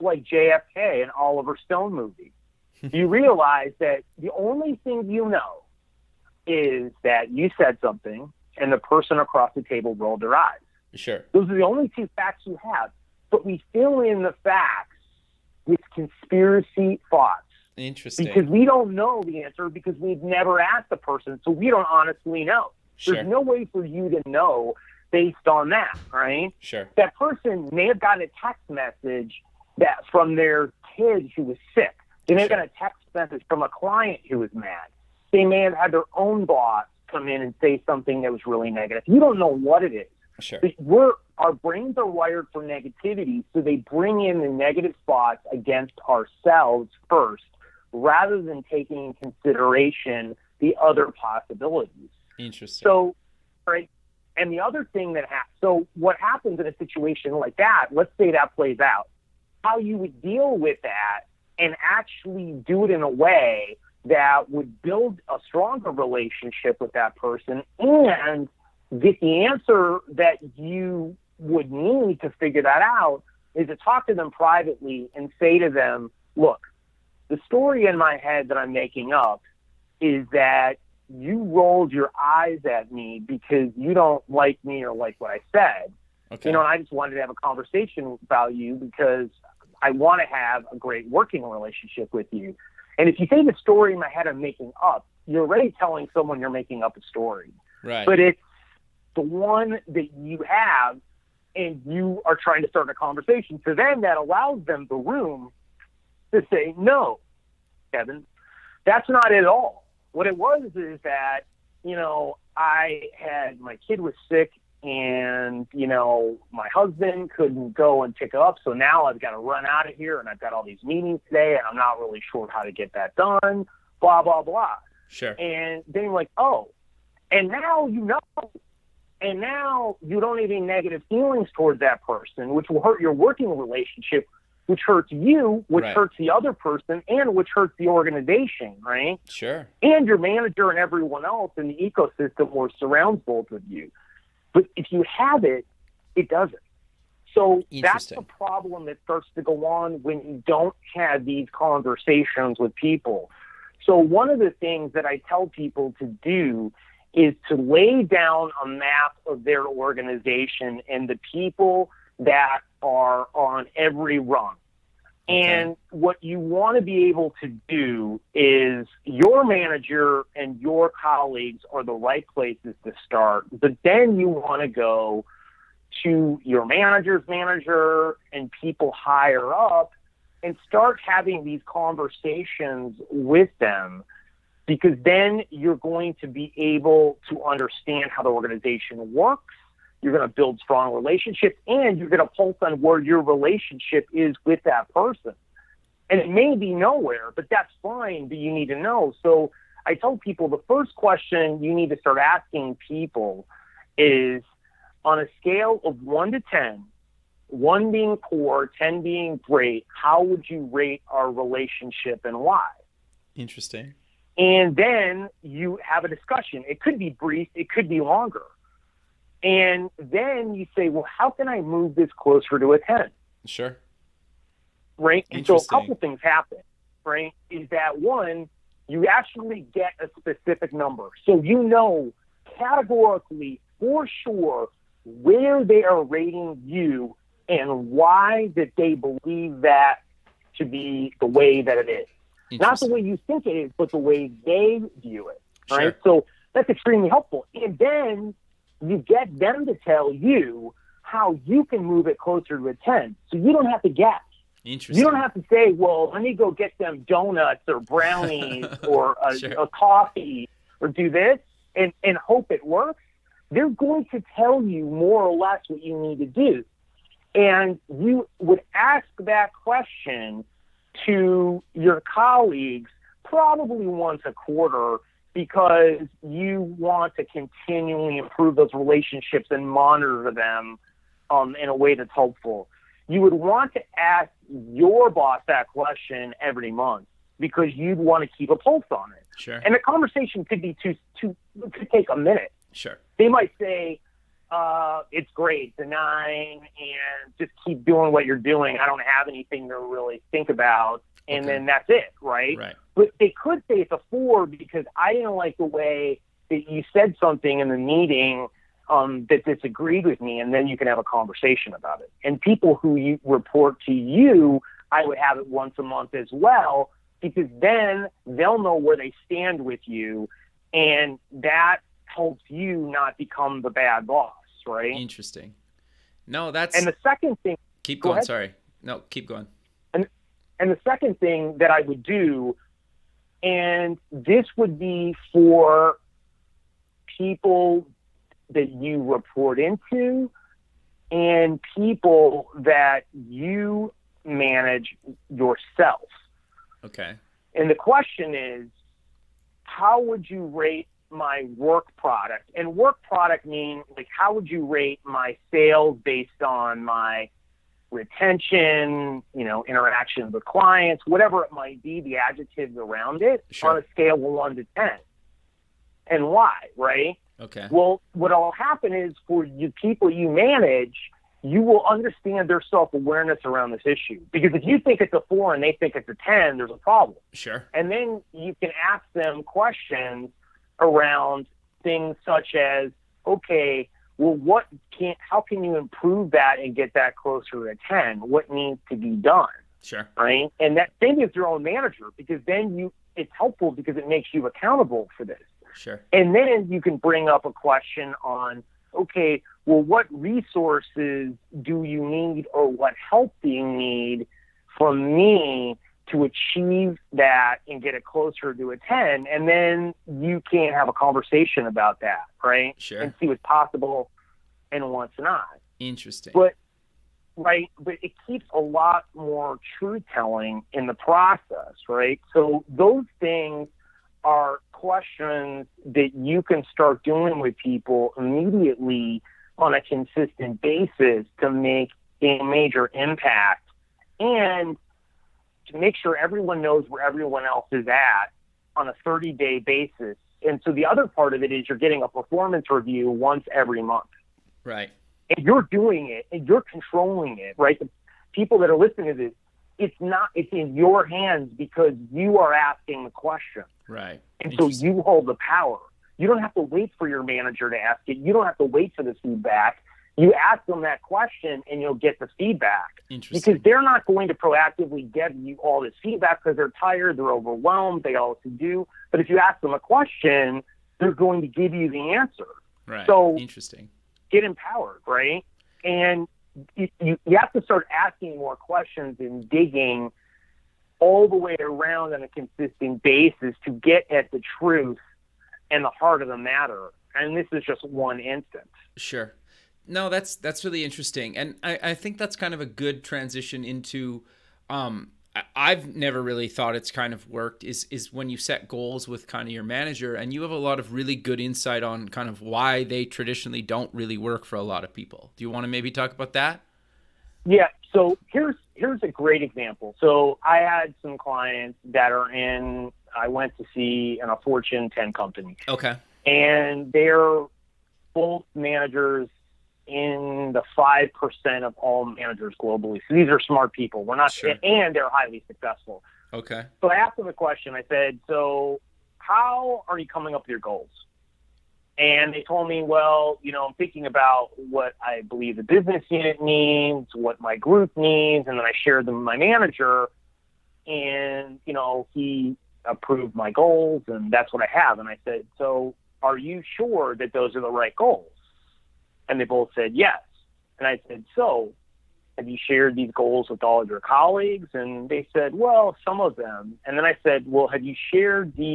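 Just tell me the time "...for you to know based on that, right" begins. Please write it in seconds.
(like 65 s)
23 s.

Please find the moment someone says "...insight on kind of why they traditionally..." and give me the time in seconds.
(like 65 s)
501 s.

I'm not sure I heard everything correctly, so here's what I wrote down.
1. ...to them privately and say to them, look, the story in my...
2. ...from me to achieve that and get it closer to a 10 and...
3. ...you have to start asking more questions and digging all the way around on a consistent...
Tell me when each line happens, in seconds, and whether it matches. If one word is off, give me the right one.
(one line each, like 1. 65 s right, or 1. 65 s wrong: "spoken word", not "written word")
1. 74 s right
2. 404 s right
3. 477 s right.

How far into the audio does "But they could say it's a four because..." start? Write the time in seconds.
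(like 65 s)
302 s.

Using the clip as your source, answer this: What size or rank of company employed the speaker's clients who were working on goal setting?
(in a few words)
Fortune 10.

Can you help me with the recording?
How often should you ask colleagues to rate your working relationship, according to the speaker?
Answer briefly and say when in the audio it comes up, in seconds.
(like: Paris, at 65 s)
once a quarter, at 273 s.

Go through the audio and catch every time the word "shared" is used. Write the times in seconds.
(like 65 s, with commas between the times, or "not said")
538 s, 552 s, 558 s.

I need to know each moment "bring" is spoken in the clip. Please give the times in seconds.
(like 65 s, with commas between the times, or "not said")
43 s, 396 s.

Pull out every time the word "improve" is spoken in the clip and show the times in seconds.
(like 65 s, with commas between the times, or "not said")
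278 s, 385 s.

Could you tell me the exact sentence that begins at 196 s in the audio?
And it may be nowhere, but that's fine, but you need to know.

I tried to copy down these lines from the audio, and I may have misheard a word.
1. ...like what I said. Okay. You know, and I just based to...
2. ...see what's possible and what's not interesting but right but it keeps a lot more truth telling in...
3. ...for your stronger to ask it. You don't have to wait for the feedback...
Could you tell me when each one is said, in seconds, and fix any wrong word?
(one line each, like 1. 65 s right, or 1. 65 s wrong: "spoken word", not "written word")
1. 84 s wrong: "wanted", not "based"
2. 413 s right
3. 456 s wrong: "manager", not "stronger".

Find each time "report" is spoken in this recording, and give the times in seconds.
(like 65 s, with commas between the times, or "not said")
313 s, 339 s.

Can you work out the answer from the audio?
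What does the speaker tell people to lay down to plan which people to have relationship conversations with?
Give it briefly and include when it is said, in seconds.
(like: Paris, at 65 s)
a map of their organization, at 158 s.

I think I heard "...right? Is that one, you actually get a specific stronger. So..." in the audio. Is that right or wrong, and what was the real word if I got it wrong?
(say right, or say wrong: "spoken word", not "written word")
wrong: "number", not "stronger".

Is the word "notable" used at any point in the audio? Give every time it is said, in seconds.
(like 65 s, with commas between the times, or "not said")
not said.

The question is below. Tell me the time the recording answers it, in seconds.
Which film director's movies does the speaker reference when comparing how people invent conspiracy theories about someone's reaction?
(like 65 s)
1 s.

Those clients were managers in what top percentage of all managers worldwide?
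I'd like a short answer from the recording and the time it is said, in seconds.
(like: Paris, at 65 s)
5%, at 520 s.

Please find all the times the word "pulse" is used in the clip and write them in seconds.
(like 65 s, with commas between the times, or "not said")
192 s, 288 s.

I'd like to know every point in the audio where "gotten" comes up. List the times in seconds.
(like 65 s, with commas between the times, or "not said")
28 s, 32 s.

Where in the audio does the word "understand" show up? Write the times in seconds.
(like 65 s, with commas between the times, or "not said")
187 s, 371 s.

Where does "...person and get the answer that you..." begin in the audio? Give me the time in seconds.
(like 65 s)
67 s.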